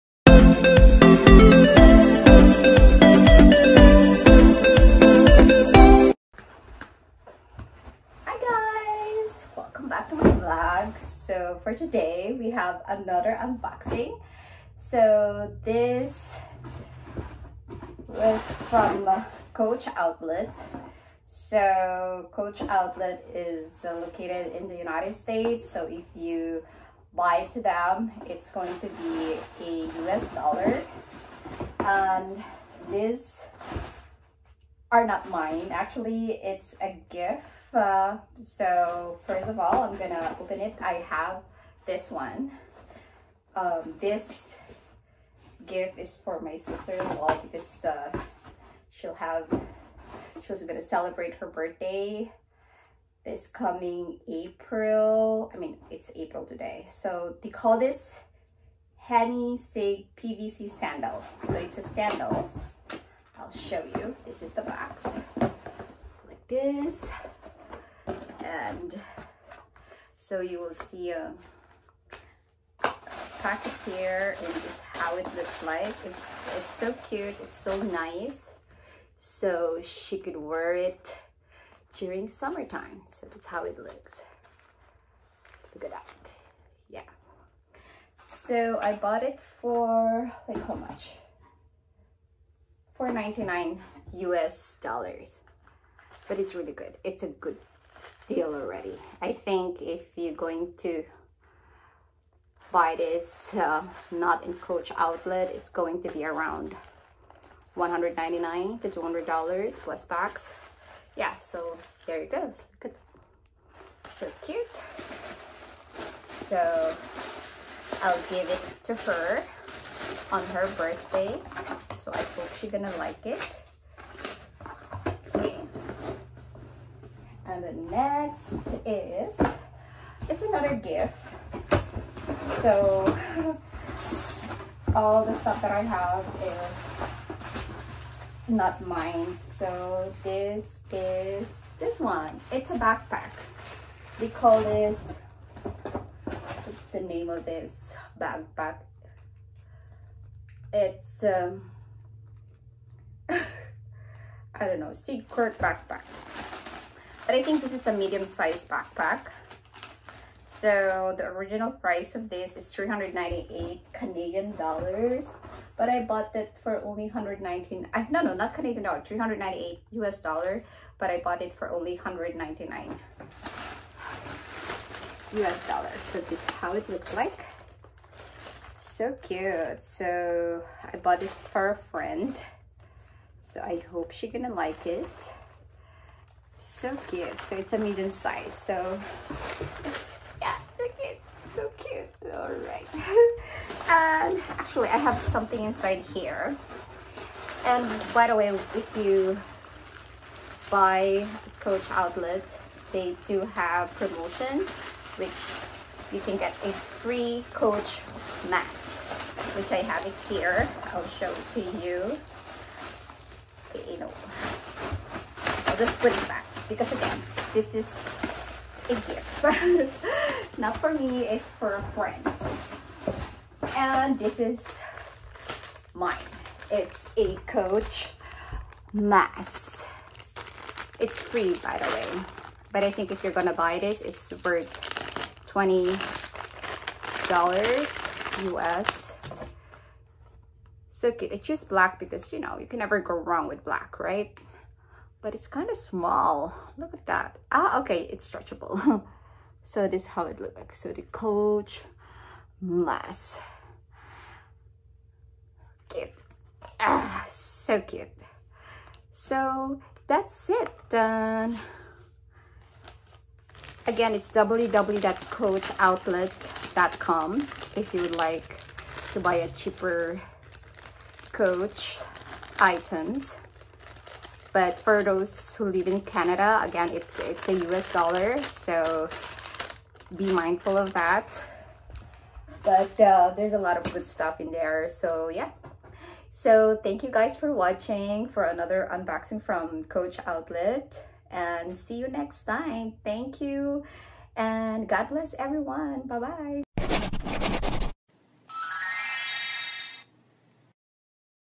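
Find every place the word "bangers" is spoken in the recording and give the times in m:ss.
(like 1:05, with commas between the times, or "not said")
not said.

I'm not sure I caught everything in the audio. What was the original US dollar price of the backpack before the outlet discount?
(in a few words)
398 US dollars.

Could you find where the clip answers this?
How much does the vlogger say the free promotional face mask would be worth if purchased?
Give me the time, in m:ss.
3:55.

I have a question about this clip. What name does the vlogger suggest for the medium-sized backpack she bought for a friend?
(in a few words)
Sigcourt backpack.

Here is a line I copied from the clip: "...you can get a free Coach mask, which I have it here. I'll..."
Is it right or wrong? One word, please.
right.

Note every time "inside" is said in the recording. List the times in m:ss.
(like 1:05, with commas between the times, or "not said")
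3:15.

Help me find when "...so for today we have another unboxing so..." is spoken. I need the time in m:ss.
0:11.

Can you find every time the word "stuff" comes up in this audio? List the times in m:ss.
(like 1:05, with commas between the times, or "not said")
2:15, 4:44.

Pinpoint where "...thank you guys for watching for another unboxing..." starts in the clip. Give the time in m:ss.
4:46.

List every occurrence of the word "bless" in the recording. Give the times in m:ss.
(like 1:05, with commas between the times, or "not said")
4:55.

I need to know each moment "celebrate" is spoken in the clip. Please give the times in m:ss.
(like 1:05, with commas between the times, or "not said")
0:50.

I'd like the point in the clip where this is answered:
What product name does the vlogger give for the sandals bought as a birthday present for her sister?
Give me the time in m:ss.
0:58.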